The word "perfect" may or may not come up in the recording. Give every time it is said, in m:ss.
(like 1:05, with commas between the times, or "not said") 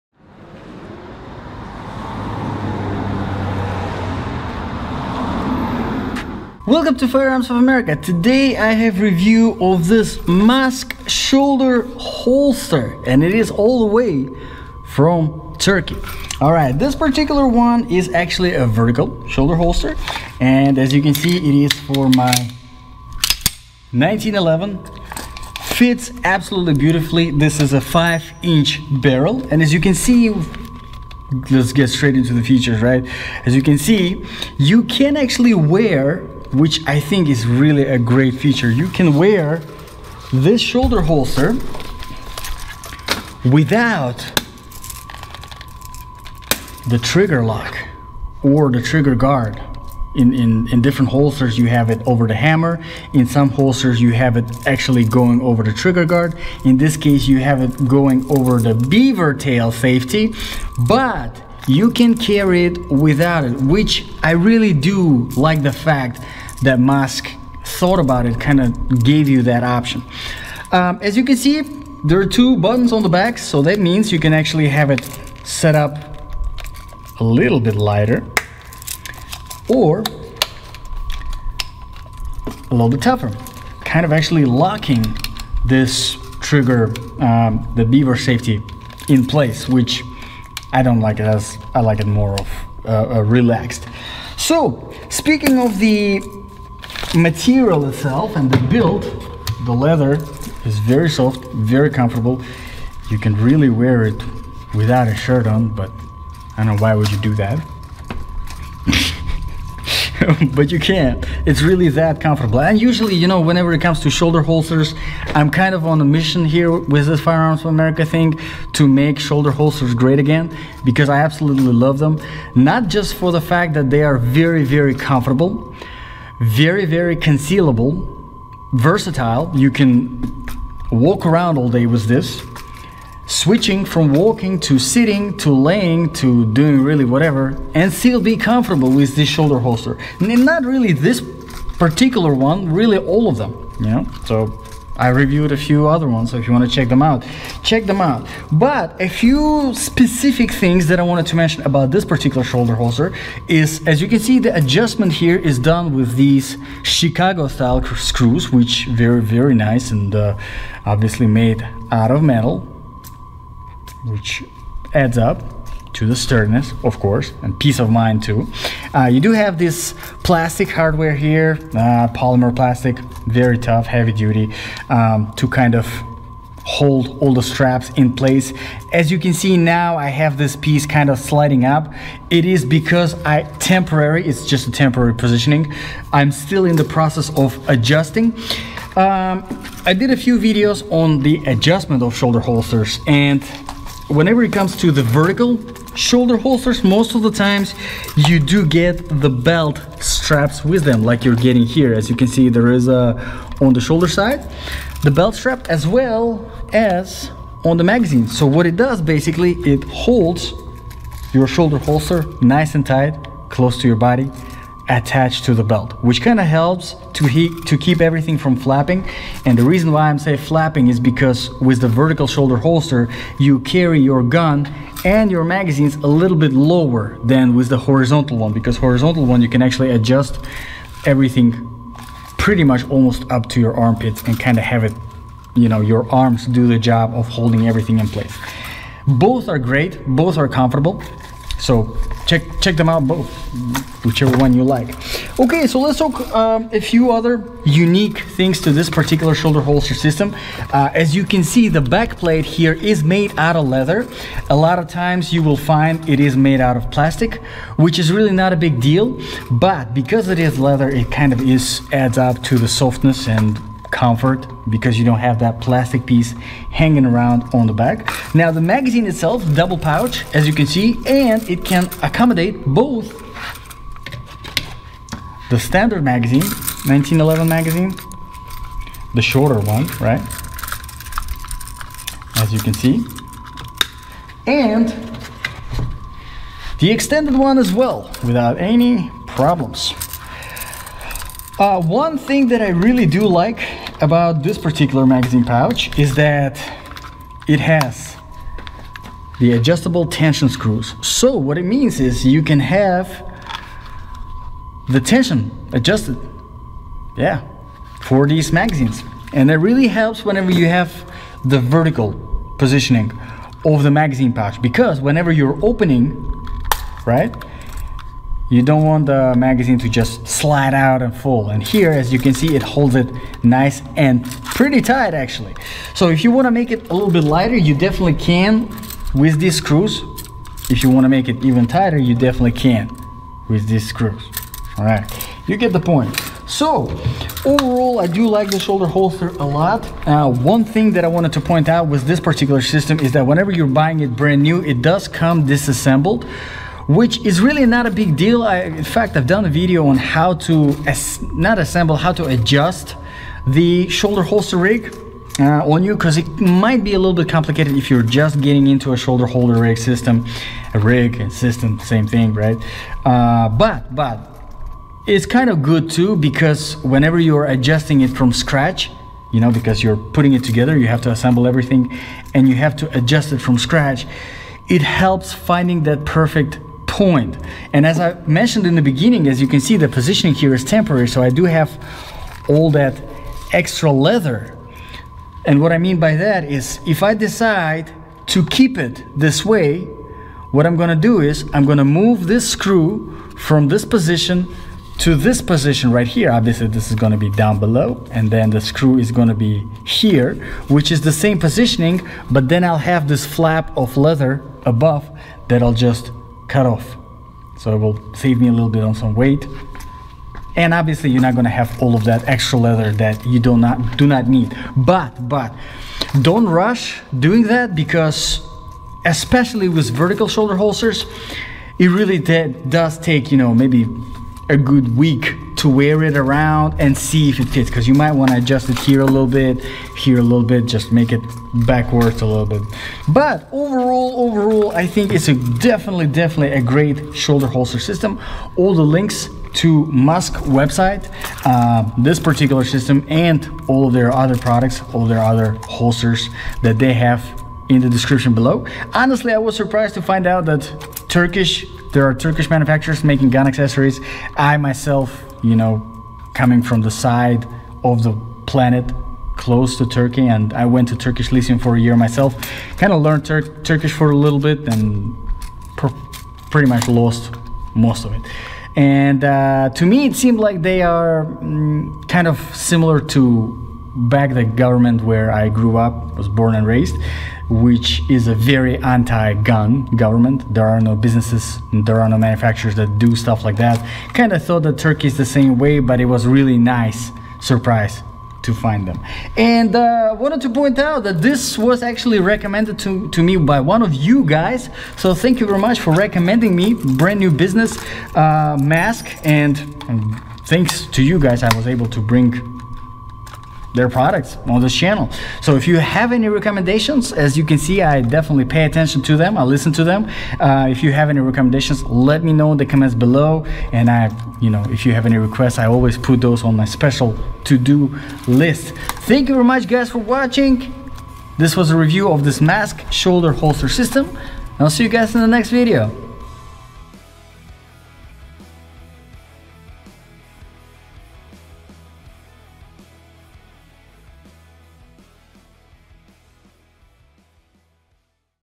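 6:16.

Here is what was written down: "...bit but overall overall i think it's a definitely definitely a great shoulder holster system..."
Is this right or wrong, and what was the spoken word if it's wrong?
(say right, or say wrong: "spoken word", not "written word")
right.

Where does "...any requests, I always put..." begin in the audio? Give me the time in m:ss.
8:35.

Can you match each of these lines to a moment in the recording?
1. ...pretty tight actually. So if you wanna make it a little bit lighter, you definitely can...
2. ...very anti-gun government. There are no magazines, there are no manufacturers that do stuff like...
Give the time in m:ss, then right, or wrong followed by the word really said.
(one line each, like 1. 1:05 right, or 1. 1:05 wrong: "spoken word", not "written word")
1. 5:24 right
2. 7:58 wrong: "businesses", not "magazines".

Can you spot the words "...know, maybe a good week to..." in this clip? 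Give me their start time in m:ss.
7:03.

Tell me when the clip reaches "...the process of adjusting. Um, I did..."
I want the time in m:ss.
3:06.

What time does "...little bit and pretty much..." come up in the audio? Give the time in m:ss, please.
7:44.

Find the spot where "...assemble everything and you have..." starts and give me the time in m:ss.
6:11.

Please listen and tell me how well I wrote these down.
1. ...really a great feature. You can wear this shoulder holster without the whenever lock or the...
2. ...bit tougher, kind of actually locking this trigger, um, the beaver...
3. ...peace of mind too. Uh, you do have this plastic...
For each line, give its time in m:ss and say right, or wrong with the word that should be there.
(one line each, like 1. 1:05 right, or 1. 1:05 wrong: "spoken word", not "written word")
1. 0:37 wrong: "trigger", not "whenever"
2. 1:22 right
3. 2:47 right.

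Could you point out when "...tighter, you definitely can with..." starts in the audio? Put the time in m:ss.
5:31.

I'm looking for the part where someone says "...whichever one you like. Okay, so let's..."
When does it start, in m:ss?
4:04.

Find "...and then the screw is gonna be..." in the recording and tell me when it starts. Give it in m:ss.
6:38.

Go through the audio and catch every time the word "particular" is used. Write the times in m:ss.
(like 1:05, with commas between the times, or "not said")
0:16, 2:21, 2:32, 4:08, 4:54, 5:42, 7:22.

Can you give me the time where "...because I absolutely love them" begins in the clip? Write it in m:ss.
2:00.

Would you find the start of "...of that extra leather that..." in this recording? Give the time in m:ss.
6:51.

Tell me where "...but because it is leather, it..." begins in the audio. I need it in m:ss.
4:19.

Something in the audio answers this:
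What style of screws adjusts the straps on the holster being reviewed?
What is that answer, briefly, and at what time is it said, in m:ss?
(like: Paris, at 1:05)
Chicago-style screws, at 2:36.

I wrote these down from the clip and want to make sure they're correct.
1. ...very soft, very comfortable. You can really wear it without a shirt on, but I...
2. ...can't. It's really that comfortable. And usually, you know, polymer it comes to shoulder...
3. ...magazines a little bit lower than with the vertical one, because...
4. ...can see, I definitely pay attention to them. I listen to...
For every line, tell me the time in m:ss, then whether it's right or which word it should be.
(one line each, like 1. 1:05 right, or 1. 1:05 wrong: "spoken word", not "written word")
1. 1:40 right
2. 1:50 wrong: "whenever", not "polymer"
3. 3:45 wrong: "horizontal", not "vertical"
4. 8:27 right.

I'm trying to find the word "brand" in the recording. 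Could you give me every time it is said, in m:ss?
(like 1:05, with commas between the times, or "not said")
5:44, 8:16.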